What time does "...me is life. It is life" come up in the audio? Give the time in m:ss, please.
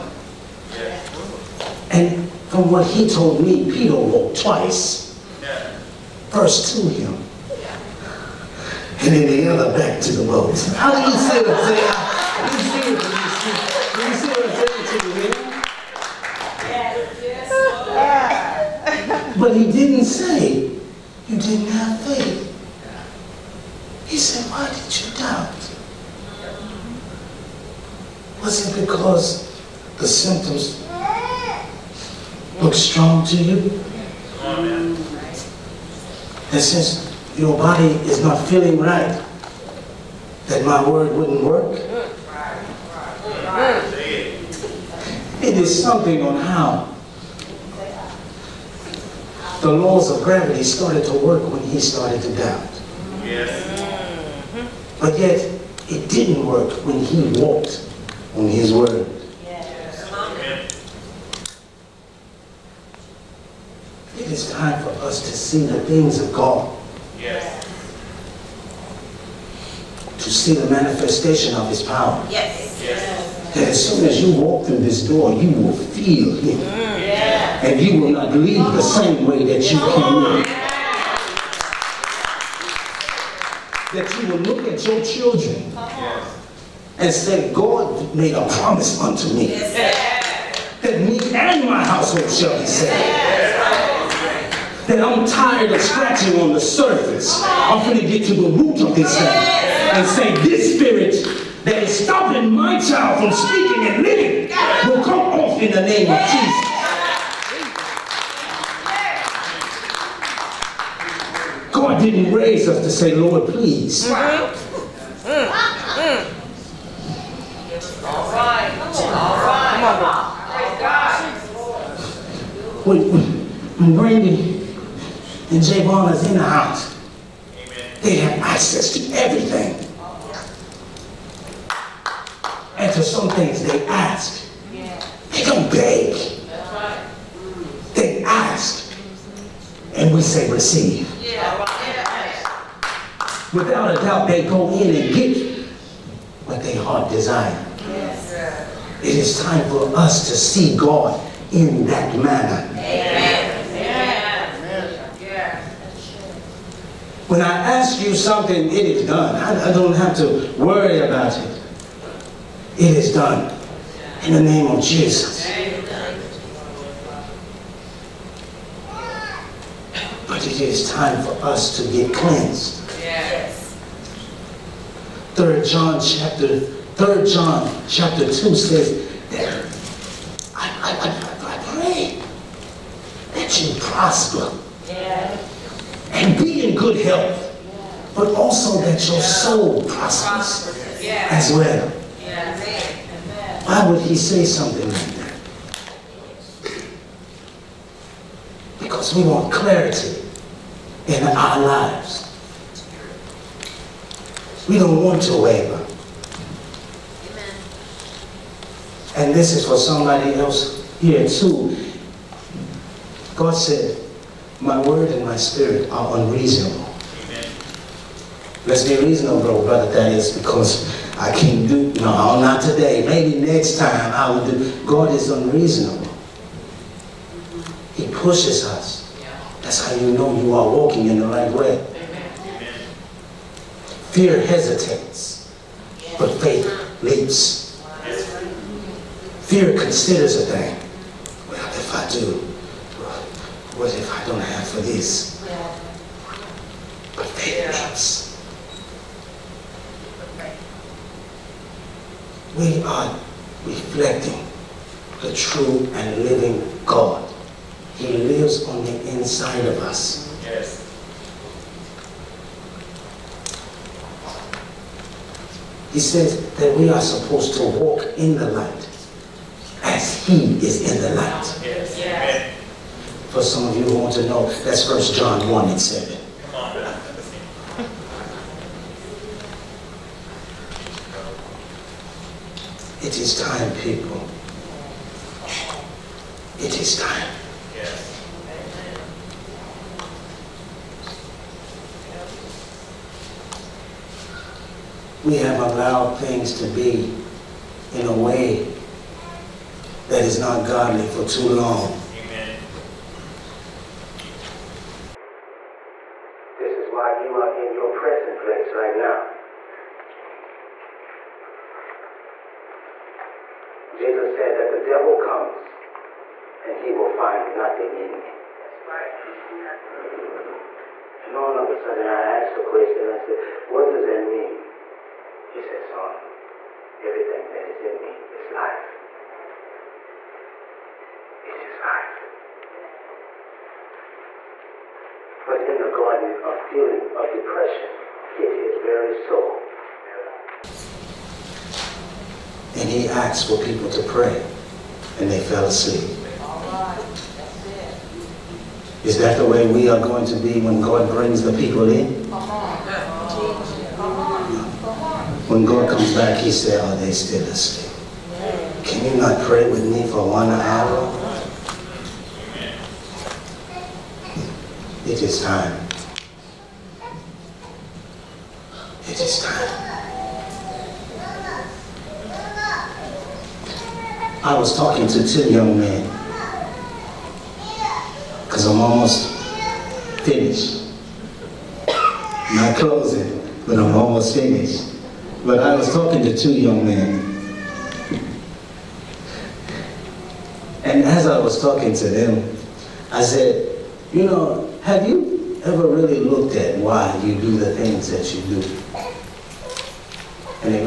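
5:28.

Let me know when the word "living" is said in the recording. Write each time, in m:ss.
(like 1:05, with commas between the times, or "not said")
1:44, 4:16.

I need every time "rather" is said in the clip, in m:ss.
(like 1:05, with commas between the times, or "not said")
not said.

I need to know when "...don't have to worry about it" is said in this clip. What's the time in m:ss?
2:39.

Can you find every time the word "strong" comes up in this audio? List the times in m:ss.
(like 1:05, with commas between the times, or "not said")
0:32.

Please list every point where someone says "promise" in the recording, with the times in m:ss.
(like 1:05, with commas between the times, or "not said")
1:28.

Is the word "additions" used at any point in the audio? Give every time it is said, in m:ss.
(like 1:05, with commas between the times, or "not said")
not said.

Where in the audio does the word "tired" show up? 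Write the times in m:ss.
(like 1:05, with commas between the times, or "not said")
1:35.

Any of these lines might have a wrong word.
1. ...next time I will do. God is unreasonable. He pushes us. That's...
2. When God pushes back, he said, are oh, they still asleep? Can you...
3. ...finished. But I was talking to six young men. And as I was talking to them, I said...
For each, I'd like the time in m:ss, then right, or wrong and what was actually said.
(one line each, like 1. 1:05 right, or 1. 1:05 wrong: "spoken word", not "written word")
1. 3:43 right
2. 5:55 wrong: "comes", not "pushes"
3. 6:24 wrong: "two", not "six".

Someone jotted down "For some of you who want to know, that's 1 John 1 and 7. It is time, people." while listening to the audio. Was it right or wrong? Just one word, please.
right.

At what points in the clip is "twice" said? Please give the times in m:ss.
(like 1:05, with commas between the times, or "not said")
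0:04.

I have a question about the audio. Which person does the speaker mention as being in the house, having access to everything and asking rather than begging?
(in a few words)
Javon.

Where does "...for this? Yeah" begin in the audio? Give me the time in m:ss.
4:04.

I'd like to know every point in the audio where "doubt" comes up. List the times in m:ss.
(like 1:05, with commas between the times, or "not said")
0:25, 0:52, 2:24.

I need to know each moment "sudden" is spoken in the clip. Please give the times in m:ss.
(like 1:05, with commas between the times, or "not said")
5:21.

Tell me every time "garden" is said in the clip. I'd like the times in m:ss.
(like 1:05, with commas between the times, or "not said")
5:35.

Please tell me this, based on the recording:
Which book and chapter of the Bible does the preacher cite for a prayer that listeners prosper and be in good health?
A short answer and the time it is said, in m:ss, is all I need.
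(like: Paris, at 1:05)
Third John chapter 2, at 2:56.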